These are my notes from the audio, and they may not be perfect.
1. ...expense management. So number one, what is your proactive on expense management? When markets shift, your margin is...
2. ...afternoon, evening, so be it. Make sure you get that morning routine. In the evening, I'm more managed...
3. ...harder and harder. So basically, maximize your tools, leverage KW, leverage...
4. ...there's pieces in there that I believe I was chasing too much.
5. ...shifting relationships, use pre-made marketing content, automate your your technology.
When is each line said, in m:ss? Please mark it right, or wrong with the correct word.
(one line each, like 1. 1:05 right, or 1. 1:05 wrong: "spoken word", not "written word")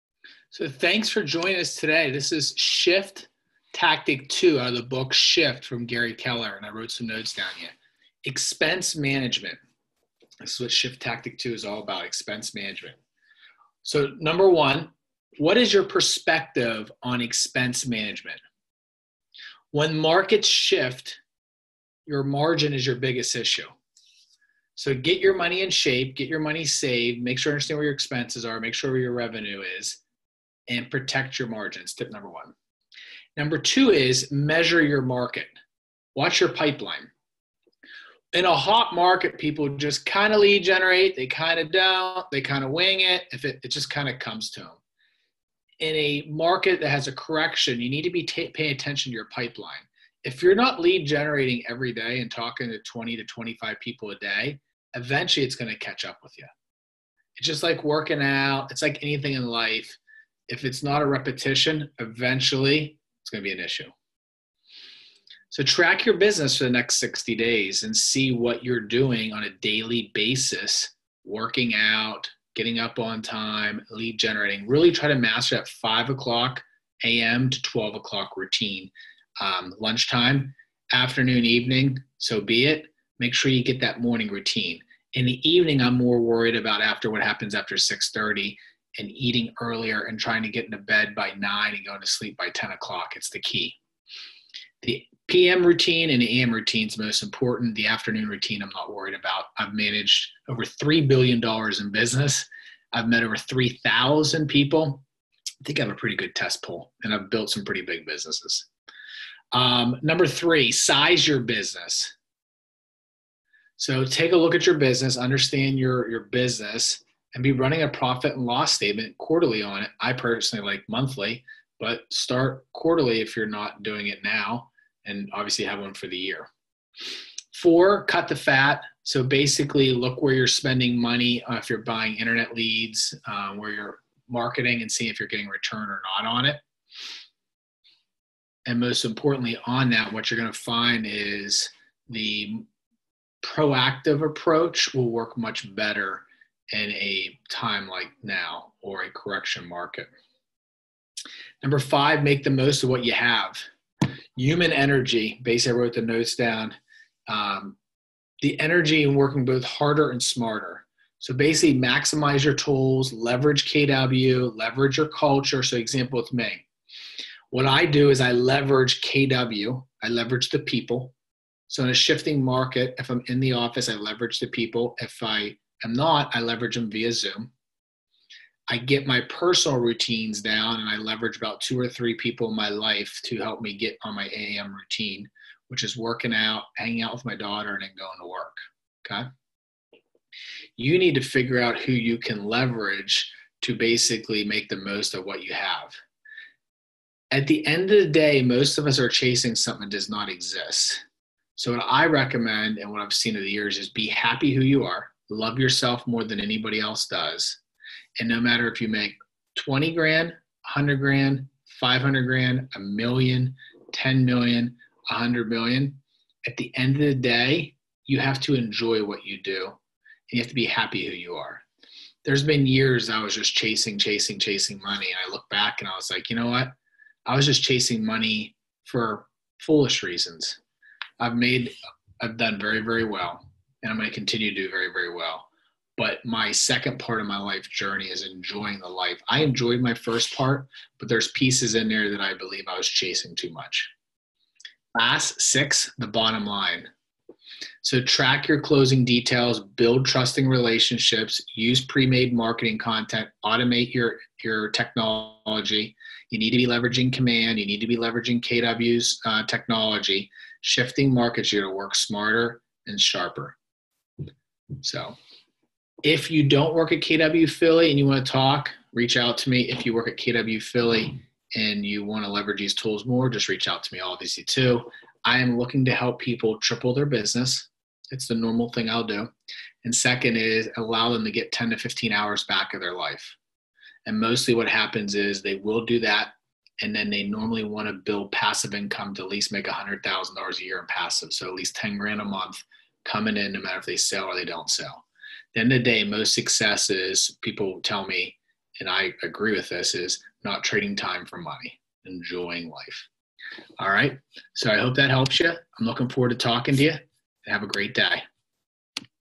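1. 0:12 wrong: "perspective", not "proactive"
2. 1:20 wrong: "worried", not "managed"
3. 2:39 wrong: "smarter", not "harder"
4. 4:01 right
5. 4:10 wrong: "trusting", not "shifting".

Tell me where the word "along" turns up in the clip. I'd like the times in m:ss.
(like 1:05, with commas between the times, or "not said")
not said.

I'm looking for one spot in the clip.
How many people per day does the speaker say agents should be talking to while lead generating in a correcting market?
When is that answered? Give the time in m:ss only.
0:52.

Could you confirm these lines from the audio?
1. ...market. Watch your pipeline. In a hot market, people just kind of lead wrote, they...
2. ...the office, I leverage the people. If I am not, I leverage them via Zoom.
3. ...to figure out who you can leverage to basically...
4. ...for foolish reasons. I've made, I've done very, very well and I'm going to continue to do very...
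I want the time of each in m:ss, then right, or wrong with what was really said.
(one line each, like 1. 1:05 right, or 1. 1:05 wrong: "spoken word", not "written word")
1. 0:35 wrong: "generate", not "wrote"
2. 2:53 right
3. 3:11 right
4. 3:48 right.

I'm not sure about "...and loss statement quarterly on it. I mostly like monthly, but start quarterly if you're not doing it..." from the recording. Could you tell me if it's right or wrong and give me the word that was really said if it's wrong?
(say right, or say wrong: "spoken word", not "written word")
wrong: "personally", not "mostly".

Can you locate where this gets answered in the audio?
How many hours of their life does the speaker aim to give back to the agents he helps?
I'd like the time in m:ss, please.
4:41.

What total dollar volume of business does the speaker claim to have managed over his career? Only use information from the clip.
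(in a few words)
$3 billion.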